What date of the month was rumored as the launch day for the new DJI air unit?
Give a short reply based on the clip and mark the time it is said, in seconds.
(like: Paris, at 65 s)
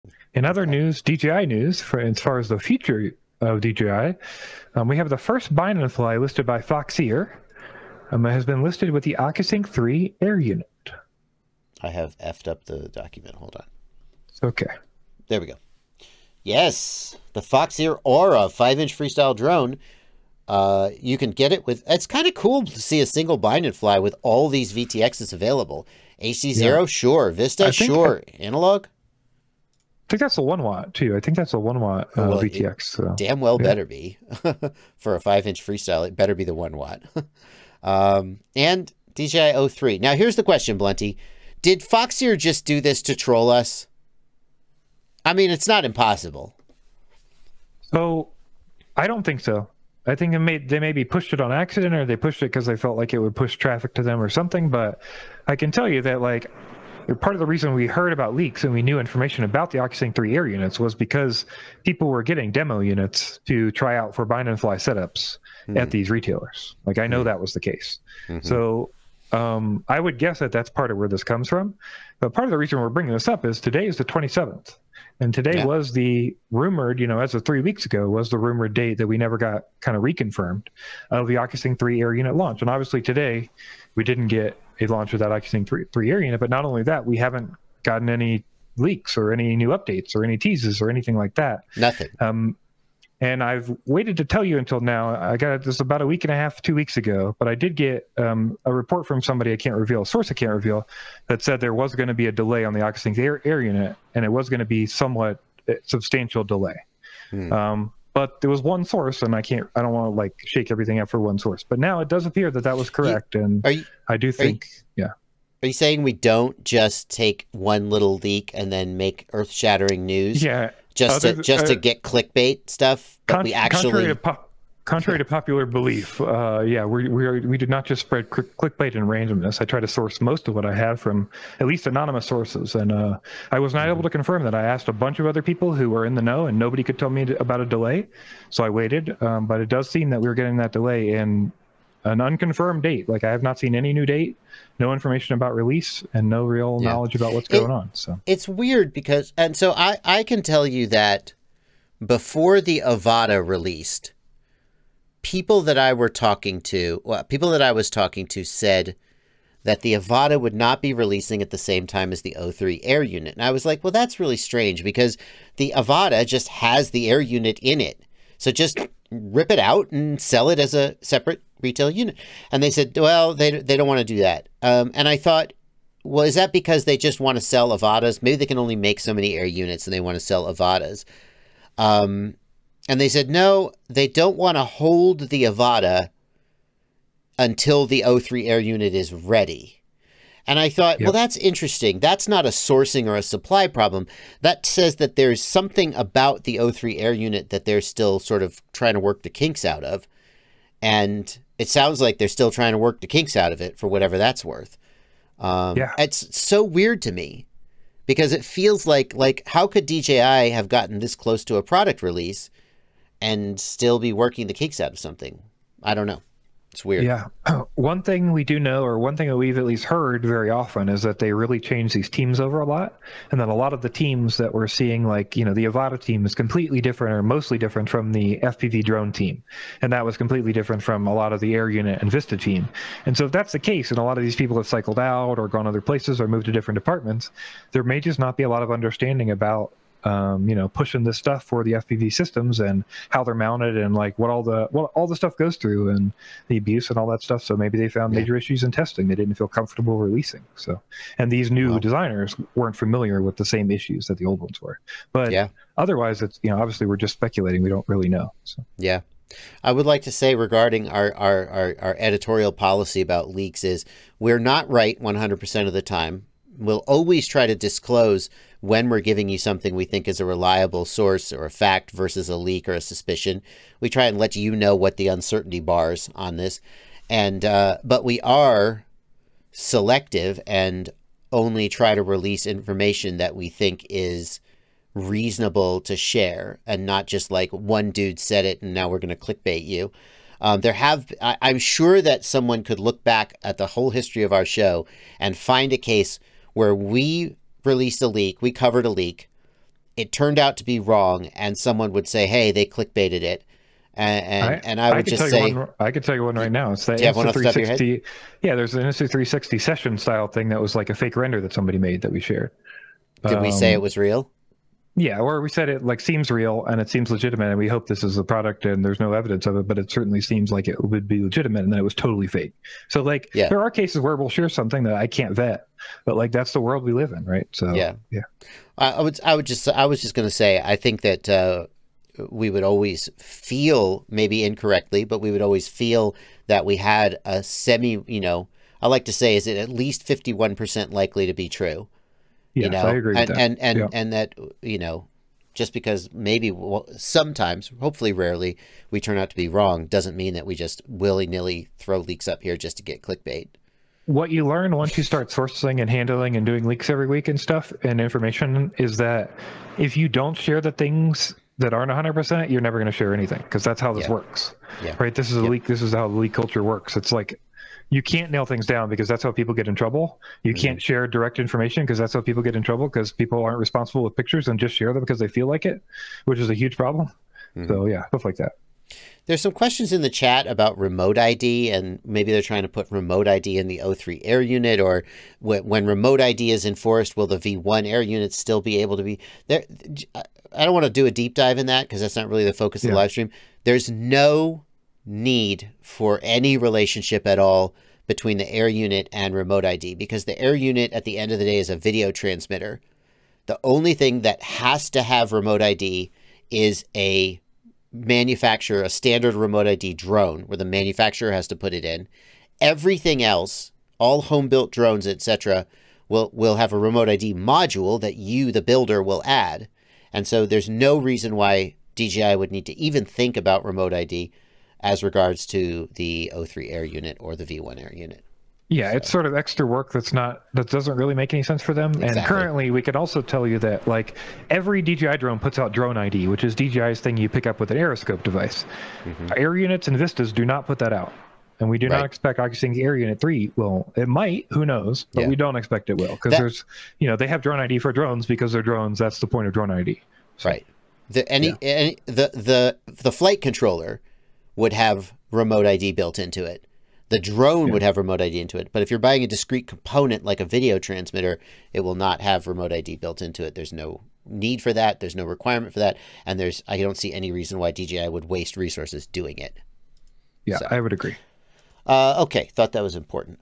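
27th, at 74 s.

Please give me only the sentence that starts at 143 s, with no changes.
Like I have not seen any new date, no information about release, and no real yeah.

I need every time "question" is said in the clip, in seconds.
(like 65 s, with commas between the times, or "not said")
40 s, 379 s.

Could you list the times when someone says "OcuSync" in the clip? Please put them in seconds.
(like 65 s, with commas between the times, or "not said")
9 s, 59 s, 81 s, 85 s, 102 s, 442 s.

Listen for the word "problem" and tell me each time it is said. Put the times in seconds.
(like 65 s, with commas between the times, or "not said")
193 s, 376 s.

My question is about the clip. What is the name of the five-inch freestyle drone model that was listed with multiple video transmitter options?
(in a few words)
Aura.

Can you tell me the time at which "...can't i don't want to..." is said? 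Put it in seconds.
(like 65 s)
109 s.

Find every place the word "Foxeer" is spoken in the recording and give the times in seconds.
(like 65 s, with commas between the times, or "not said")
6 s, 17 s, 41 s.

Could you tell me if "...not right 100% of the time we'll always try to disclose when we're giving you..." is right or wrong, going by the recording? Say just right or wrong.
right.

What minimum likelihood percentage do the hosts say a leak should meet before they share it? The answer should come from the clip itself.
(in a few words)
51%.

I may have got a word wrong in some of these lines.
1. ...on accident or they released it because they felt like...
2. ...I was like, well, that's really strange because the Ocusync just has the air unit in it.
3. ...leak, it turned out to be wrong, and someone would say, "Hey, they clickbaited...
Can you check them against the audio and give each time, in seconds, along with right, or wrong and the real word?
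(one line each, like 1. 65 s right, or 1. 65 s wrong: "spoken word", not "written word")
1. 51 s wrong: "pushed", not "released"
2. 163 s wrong: "Avata", not "Ocusync"
3. 298 s right.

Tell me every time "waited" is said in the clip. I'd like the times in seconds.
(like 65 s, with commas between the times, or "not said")
93 s, 138 s.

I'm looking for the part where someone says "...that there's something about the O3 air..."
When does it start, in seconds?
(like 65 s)
194 s.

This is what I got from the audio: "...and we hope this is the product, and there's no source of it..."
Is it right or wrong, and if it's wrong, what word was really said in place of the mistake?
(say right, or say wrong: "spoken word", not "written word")
wrong: "evidence", not "source".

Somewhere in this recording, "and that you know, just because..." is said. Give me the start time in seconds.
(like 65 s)
343 s.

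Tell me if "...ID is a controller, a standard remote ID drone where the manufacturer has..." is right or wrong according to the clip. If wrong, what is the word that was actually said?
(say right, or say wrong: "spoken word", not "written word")
wrong: "manufacturer", not "controller".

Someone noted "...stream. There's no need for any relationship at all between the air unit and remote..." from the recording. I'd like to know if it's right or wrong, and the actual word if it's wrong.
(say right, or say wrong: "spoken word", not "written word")
right.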